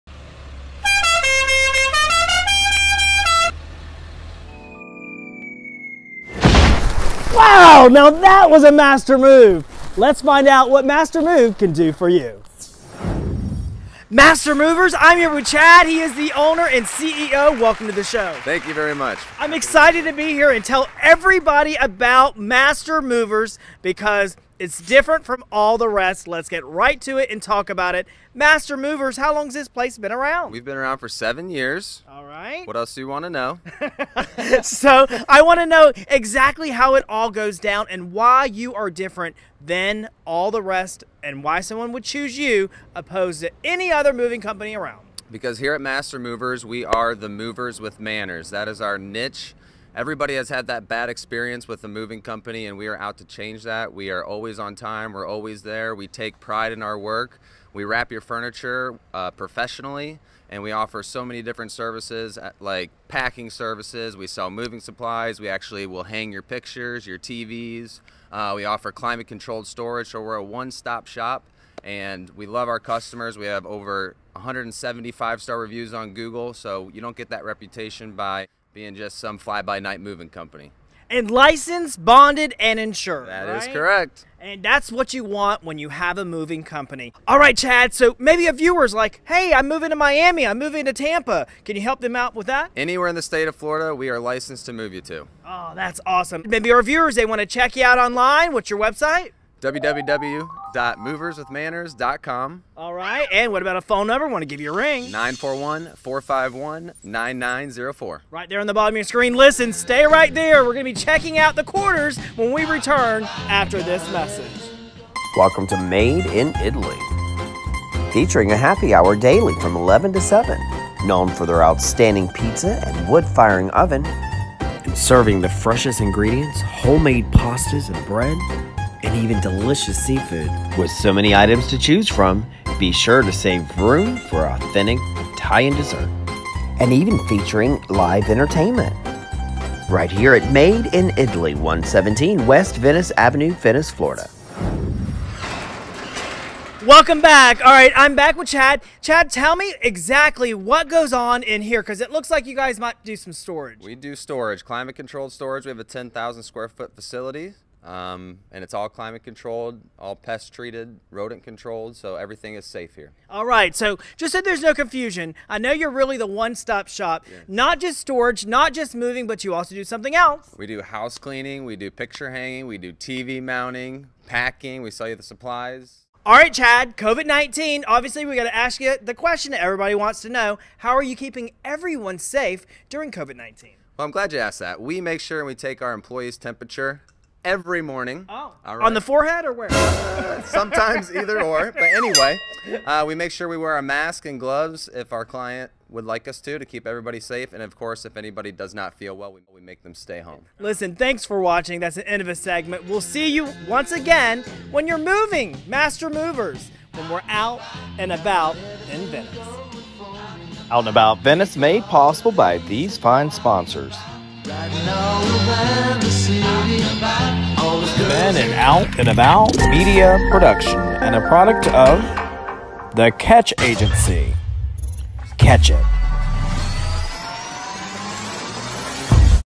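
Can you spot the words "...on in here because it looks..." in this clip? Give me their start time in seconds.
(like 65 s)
151 s.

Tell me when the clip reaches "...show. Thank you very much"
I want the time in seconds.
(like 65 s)
18 s.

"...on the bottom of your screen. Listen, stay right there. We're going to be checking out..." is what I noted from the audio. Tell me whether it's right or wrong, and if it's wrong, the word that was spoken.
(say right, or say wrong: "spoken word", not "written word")
right.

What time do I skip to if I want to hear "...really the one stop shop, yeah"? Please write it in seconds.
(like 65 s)
165 s.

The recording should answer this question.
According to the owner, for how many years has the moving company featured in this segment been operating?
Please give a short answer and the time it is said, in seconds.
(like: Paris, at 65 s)
7 years, at 31 s.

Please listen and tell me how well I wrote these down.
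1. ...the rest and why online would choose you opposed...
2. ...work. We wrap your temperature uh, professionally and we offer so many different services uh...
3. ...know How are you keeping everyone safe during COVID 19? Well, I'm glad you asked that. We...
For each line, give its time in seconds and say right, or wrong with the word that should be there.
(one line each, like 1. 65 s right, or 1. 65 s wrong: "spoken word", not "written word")
1. 40 s wrong: "someone", not "online"
2. 56 s wrong: "furniture", not "temperature"
3. 180 s right.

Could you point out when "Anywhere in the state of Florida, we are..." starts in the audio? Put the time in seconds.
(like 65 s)
92 s.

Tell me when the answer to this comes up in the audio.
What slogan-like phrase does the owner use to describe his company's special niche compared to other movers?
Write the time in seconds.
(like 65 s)
47 s.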